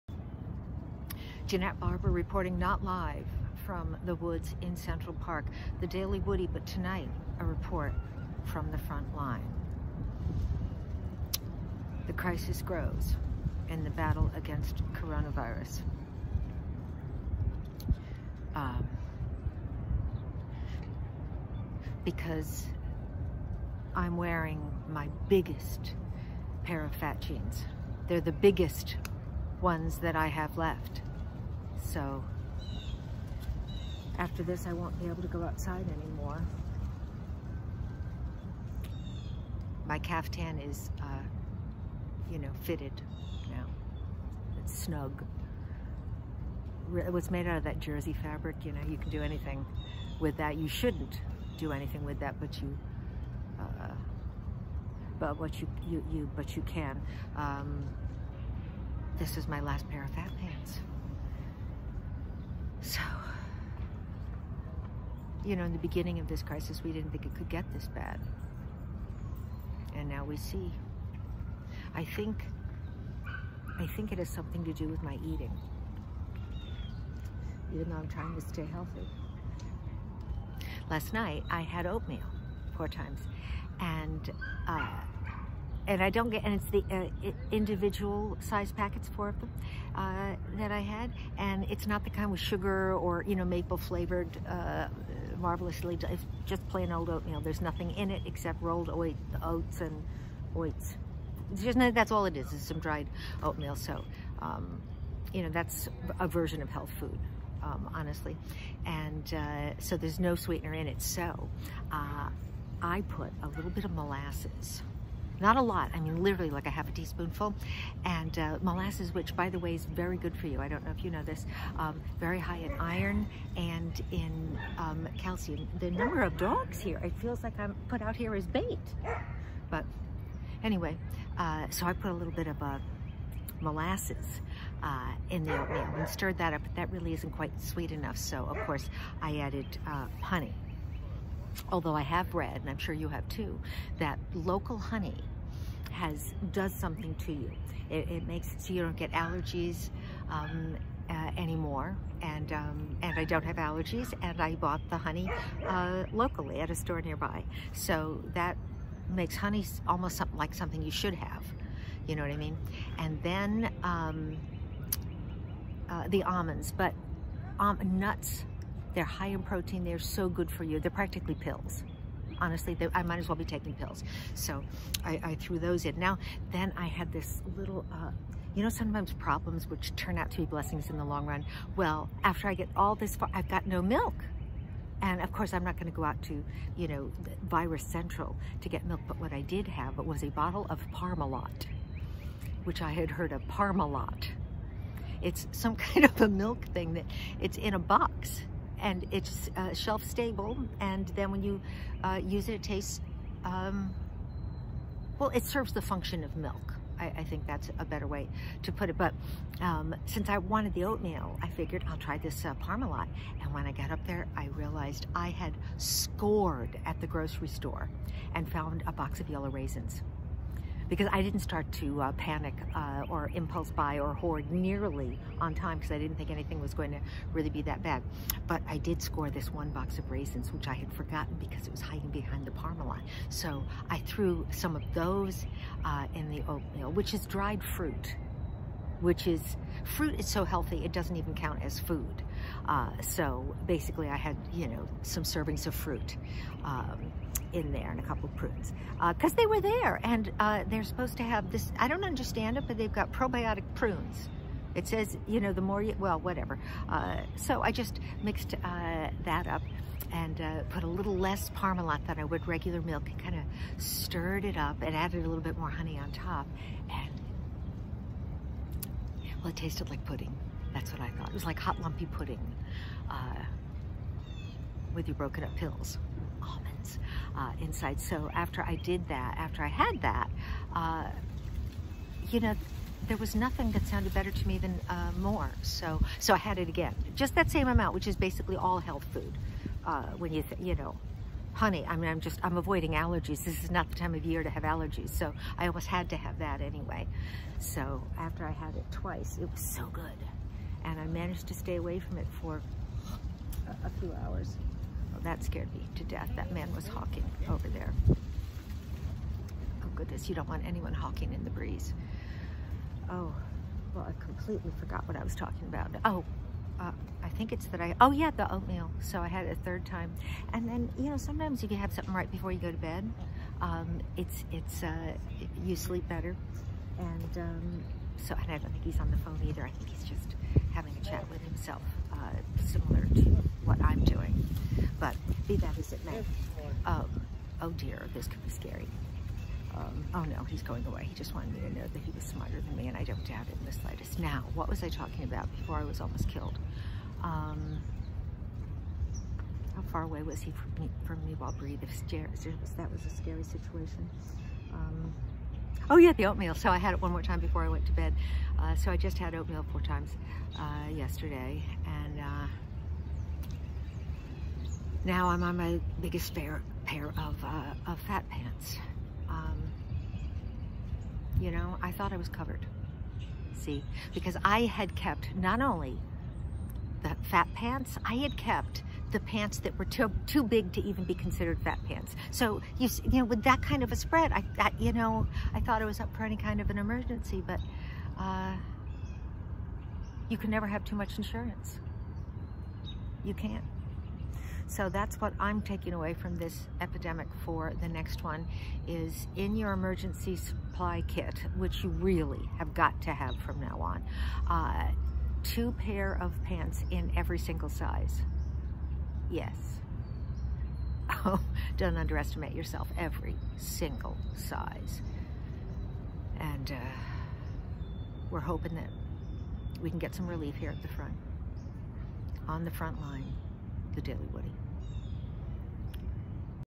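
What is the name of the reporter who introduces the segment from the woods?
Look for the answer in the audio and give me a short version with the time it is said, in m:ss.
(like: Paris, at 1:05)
Janette Barber, at 0:01.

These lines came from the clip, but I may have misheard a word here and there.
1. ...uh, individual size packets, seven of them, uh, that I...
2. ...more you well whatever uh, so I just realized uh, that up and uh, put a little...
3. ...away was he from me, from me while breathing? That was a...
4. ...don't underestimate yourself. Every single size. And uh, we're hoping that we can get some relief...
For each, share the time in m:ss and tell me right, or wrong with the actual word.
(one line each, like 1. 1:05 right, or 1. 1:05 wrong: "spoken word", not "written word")
1. 1:26 wrong: "four", not "seven"
2. 4:15 wrong: "mixed", not "realized"
3. 5:50 right
4. 6:51 right.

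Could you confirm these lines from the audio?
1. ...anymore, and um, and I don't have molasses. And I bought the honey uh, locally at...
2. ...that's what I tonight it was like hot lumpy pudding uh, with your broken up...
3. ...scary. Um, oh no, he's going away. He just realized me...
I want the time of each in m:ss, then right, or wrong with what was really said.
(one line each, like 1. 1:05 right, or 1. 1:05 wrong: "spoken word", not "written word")
1. 2:31 wrong: "allergies", not "molasses"
2. 4:30 wrong: "thought", not "tonight"
3. 5:38 wrong: "wanted", not "realized".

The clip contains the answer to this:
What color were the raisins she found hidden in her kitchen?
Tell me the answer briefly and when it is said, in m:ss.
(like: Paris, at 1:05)
yellow, at 3:39.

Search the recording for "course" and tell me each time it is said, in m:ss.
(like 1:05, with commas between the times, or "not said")
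2:18, 3:05.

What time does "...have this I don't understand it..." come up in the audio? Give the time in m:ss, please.
4:11.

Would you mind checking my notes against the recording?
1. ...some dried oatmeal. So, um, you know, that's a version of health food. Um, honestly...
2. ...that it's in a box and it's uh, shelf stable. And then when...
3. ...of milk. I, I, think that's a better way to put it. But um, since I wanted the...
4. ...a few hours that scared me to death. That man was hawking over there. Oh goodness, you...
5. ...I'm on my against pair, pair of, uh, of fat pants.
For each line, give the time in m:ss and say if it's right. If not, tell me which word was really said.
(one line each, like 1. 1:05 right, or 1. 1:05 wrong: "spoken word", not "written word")
1. 1:42 right
2. 3:16 right
3. 3:26 right
4. 5:03 right
5. 6:05 wrong: "biggest", not "against".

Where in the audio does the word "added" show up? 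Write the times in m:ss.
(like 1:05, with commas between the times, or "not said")
2:19, 4:24.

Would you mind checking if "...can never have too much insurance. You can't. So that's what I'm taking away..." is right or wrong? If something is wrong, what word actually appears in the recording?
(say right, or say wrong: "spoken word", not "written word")
right.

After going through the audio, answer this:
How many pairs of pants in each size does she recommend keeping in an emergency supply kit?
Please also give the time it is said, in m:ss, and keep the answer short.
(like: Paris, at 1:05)
2, at 6:45.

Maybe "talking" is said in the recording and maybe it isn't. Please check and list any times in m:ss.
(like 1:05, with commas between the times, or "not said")
5:15, 5:44.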